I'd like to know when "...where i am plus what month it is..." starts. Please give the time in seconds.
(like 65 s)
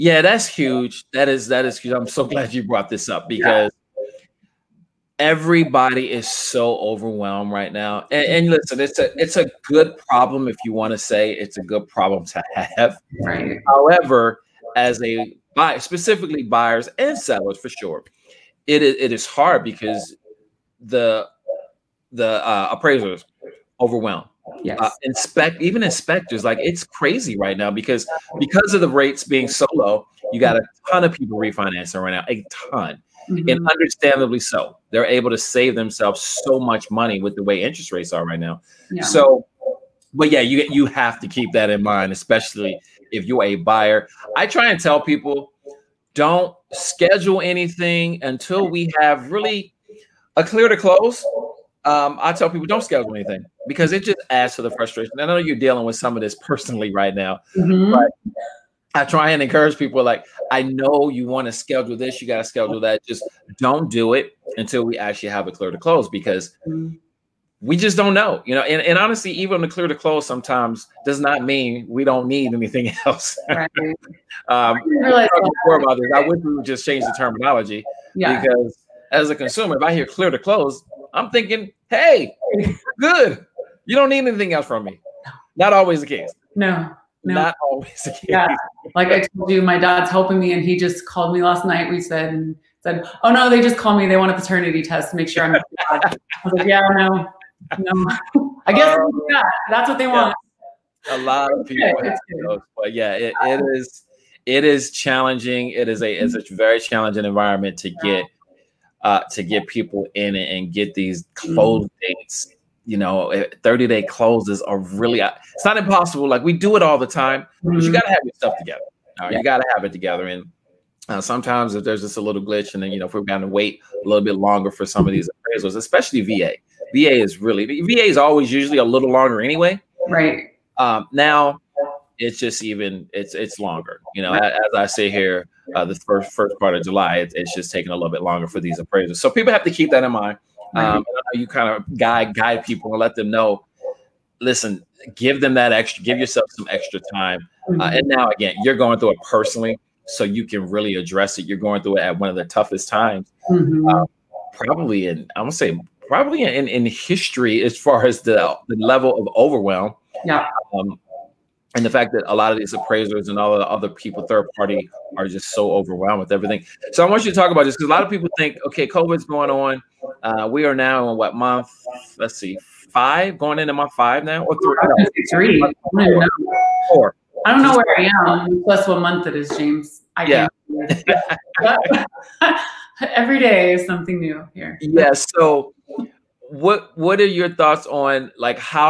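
177 s.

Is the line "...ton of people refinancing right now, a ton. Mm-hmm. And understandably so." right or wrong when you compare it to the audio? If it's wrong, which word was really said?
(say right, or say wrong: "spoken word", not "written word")
right.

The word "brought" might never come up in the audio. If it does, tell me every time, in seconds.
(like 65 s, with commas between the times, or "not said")
2 s.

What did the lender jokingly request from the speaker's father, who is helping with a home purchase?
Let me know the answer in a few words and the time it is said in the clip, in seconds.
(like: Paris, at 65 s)
A paternity test, at 94 s.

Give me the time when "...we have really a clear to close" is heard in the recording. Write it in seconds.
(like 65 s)
48 s.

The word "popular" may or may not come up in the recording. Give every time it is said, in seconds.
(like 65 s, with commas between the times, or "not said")
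not said.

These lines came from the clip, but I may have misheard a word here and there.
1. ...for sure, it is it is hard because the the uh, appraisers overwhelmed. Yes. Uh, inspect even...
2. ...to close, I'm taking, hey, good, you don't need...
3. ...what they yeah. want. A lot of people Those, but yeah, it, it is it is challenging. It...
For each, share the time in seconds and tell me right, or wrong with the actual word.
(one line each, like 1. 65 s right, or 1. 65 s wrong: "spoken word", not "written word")
1. 17 s right
2. 80 s wrong: "thinking", not "taking"
3. 99 s right.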